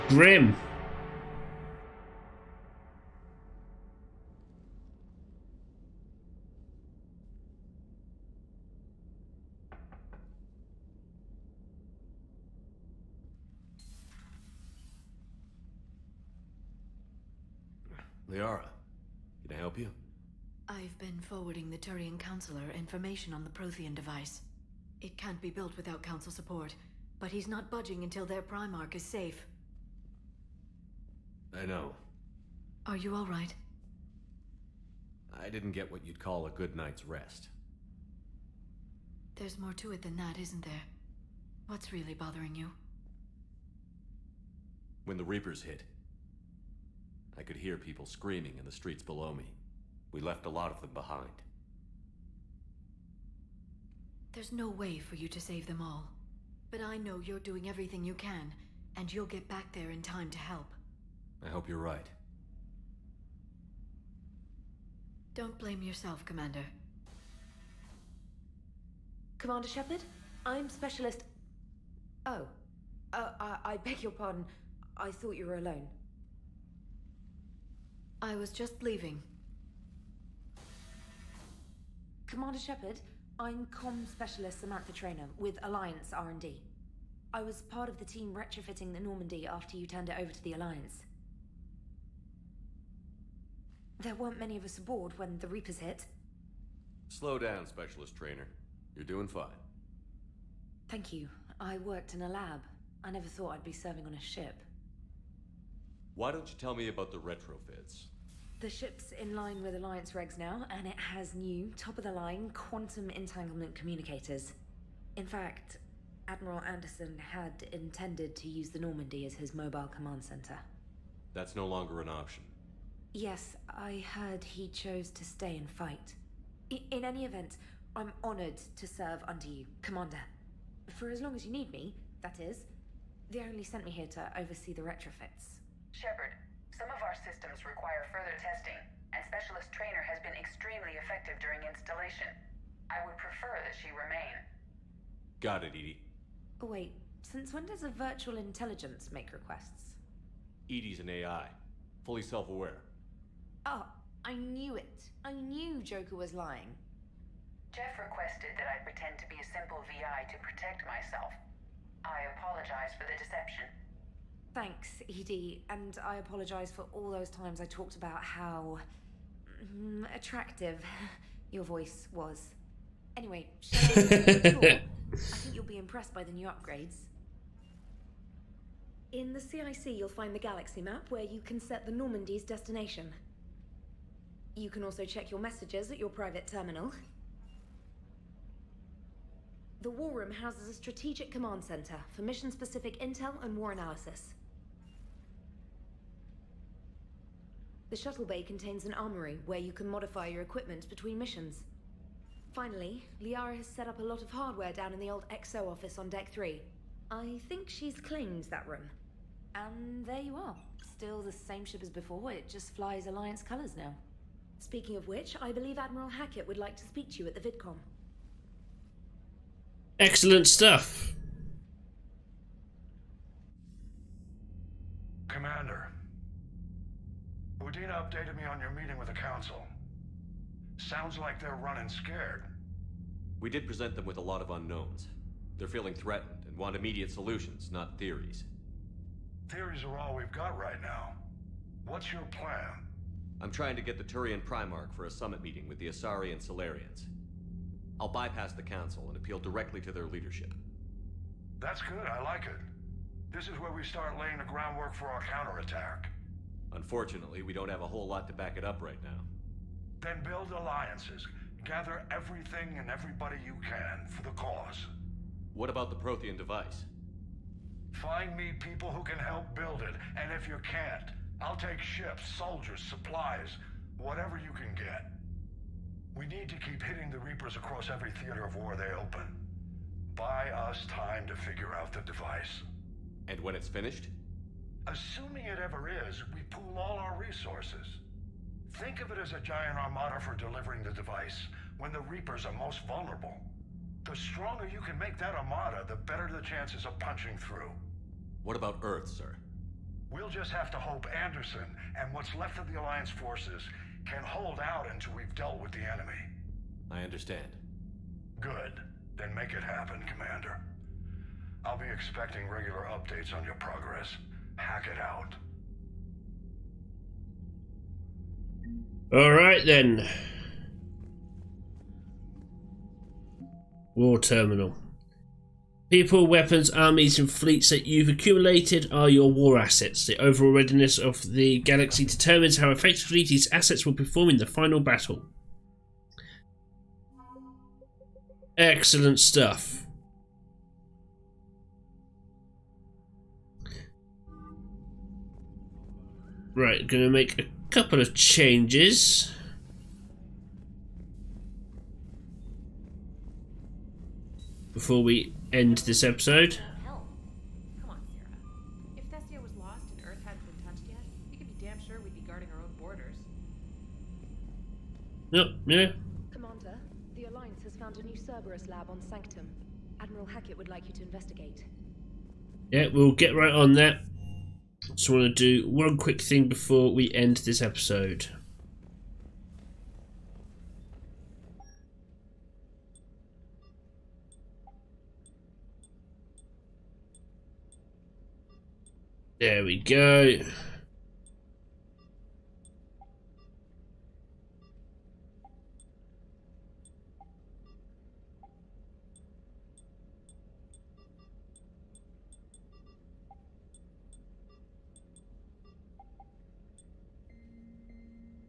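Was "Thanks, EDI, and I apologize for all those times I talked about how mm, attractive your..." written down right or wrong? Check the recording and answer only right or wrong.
right.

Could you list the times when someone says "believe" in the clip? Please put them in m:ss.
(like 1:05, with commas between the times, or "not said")
3:35.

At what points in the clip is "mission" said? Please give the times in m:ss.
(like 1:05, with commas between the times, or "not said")
3:12, 3:21.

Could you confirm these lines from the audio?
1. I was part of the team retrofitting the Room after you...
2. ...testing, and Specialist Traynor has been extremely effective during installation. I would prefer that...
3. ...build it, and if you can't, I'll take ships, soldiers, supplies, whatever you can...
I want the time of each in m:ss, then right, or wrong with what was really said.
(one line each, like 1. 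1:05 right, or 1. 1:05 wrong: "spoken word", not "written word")
1. 1:27 wrong: "Normandy", not "Room"
2. 2:18 right
3. 4:29 right.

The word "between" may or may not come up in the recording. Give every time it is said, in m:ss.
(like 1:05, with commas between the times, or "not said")
3:20.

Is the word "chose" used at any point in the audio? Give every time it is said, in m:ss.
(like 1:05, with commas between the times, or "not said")
2:04.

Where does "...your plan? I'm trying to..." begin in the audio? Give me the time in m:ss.
4:02.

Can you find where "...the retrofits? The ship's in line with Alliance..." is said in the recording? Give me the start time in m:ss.
1:47.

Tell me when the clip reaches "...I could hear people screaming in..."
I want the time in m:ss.
0:47.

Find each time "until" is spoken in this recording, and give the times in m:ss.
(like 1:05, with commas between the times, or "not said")
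0:28, 5:04.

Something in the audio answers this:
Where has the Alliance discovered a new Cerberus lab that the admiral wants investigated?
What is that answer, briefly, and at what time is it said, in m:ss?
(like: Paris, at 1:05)
Sanctum, at 6:09.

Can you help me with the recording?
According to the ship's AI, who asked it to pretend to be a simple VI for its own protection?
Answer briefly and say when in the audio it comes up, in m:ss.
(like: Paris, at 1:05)
Jeff, at 2:37.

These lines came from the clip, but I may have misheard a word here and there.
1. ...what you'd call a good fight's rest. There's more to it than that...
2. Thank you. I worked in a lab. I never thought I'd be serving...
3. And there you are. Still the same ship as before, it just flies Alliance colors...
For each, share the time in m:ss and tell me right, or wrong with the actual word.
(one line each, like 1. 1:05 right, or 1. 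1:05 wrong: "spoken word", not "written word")
1. 0:35 wrong: "night", not "fight"
2. 1:40 right
3. 3:29 right.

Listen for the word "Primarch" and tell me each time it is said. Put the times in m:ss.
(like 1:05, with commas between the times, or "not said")
0:28, 4:04.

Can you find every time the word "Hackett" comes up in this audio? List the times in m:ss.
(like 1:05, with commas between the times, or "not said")
3:36, 6:10.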